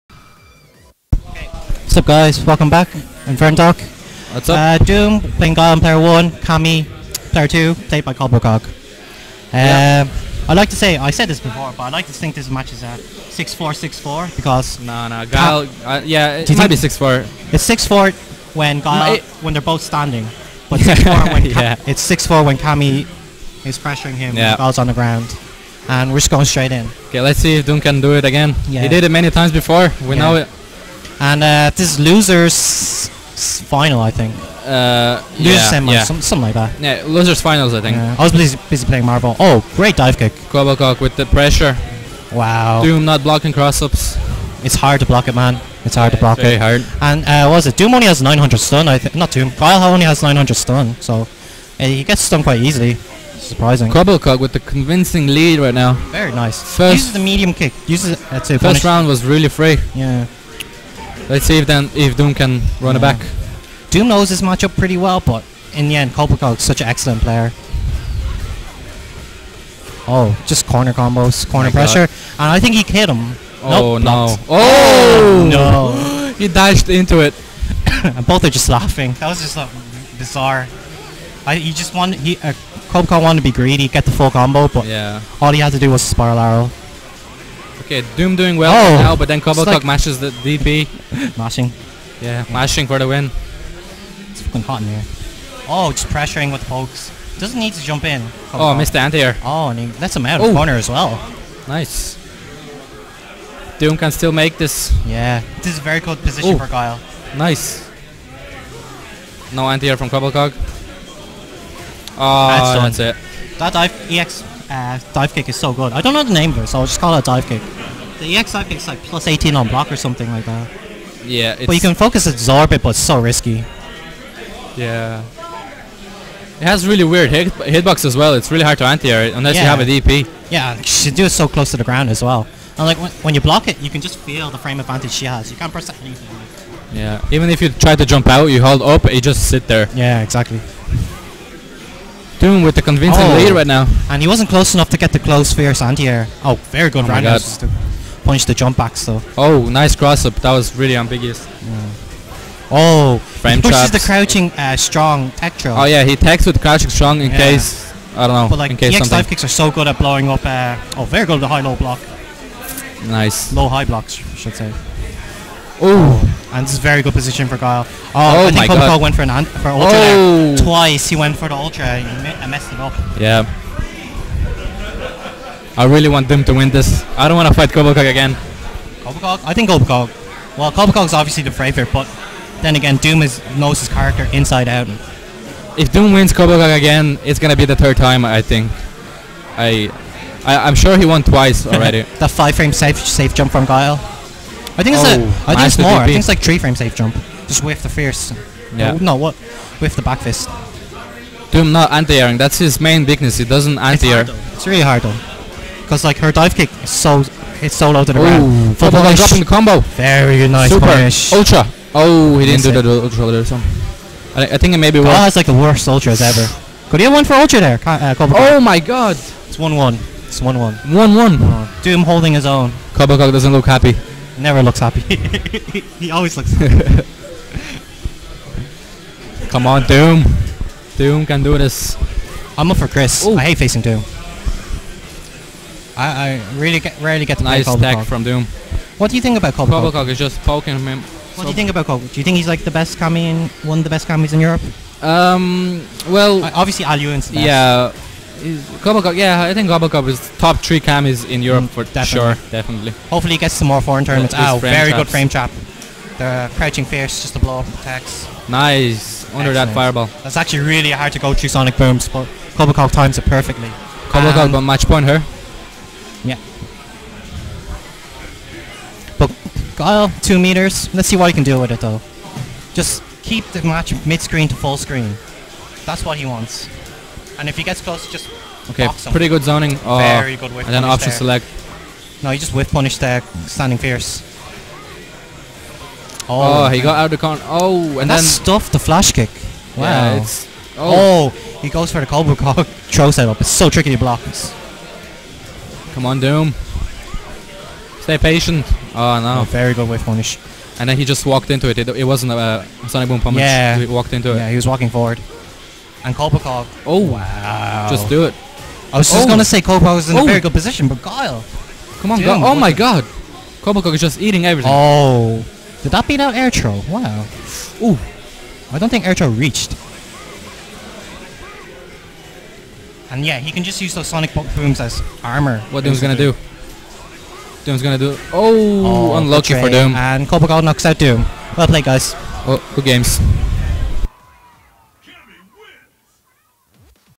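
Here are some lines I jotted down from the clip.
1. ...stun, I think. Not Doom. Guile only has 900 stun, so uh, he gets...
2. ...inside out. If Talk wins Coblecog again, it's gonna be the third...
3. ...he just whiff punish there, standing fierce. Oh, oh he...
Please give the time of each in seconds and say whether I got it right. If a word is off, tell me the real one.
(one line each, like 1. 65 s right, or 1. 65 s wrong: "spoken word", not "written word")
1. 48 s right
2. 184 s wrong: "Doom", not "Talk"
3. 282 s right.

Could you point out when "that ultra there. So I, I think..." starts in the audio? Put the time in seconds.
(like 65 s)
212 s.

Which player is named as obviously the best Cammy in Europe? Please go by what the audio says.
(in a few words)
Aluin.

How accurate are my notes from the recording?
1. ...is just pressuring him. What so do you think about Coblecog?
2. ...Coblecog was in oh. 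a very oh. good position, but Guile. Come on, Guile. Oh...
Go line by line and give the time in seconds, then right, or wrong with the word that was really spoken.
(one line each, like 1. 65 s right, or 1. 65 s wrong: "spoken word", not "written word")
1. 240 s wrong: "poking", not "pressuring"
2. 309 s right.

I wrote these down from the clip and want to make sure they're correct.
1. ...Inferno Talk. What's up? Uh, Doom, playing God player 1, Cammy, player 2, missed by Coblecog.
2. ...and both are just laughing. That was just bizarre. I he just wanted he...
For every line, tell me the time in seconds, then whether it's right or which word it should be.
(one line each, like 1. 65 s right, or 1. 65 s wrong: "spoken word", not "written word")
1. 3 s wrong: "played", not "missed"
2. 78 s right.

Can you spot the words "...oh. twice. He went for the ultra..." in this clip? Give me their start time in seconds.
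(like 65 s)
169 s.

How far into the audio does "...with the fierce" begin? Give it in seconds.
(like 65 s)
197 s.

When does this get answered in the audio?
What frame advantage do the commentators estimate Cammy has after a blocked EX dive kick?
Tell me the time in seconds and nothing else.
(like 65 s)
118 s.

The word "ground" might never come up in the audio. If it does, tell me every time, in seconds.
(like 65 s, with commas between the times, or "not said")
24 s, 131 s, 208 s.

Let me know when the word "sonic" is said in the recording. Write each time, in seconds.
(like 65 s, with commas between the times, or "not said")
261 s, 302 s, 324 s.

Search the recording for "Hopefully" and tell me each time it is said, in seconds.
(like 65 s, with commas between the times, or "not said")
253 s.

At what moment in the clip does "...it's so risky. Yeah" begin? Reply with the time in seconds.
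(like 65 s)
122 s.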